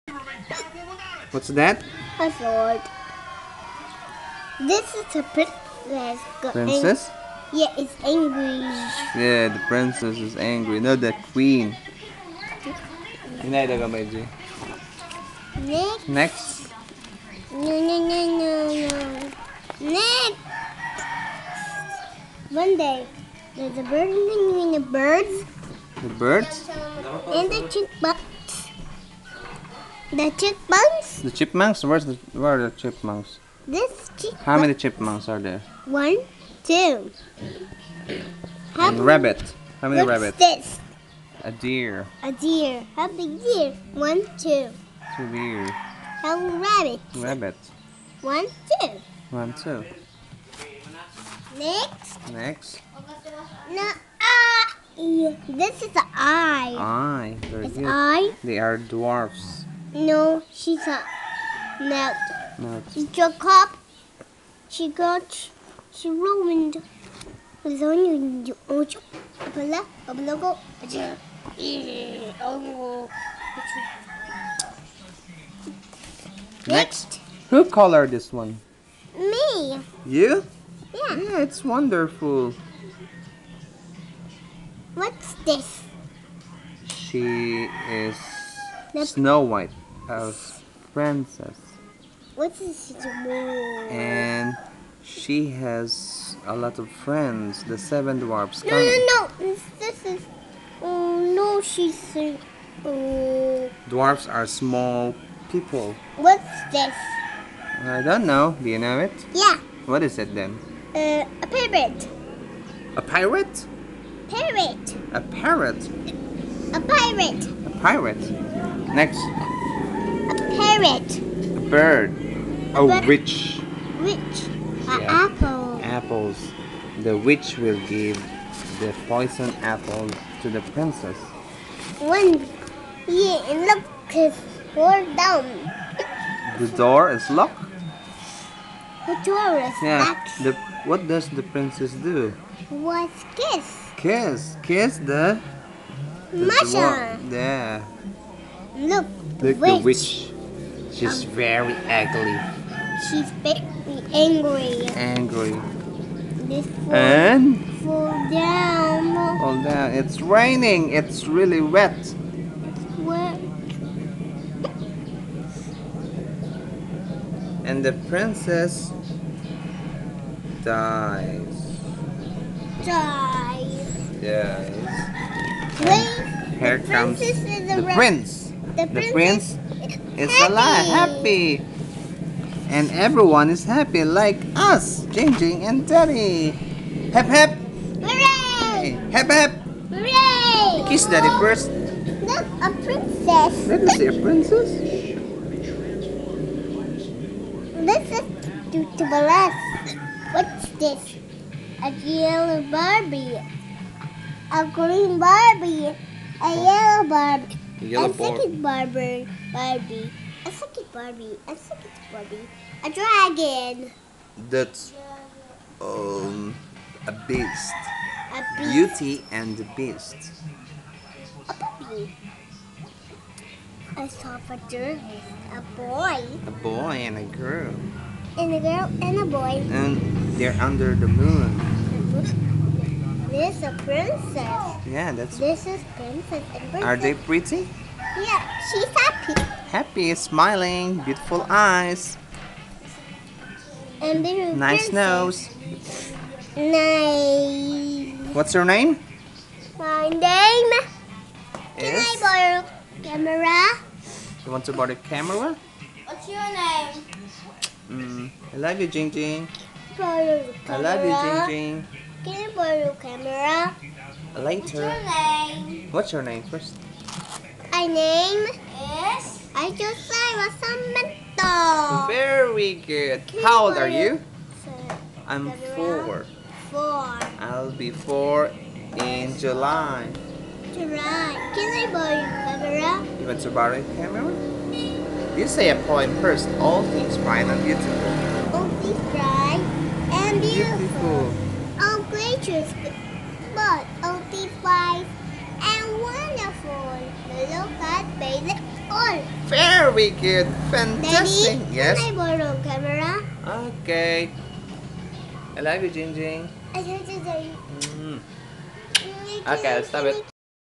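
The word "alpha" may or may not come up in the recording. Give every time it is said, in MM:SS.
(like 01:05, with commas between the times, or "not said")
not said.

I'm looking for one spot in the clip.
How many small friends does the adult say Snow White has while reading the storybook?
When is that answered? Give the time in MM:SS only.
01:37.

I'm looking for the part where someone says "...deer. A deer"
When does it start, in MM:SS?
00:41.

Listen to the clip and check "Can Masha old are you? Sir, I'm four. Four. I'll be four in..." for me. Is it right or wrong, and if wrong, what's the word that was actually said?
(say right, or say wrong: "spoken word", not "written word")
wrong: "How", not "Masha".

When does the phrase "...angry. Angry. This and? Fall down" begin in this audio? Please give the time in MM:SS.
02:34.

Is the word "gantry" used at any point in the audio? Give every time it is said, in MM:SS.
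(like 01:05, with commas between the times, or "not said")
not said.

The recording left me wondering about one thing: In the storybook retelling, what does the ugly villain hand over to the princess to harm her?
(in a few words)
poison apples.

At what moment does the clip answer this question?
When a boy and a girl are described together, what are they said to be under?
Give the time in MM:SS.
03:51.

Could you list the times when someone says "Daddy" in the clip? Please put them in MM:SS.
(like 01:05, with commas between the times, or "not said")
03:05, 03:11, 05:01.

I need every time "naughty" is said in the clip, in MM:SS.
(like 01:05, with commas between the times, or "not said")
not said.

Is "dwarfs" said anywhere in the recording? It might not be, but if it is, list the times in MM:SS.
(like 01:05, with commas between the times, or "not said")
00:58, 01:38, 01:43.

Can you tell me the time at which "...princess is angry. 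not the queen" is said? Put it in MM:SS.
00:09.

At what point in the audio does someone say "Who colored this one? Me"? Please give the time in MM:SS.
01:17.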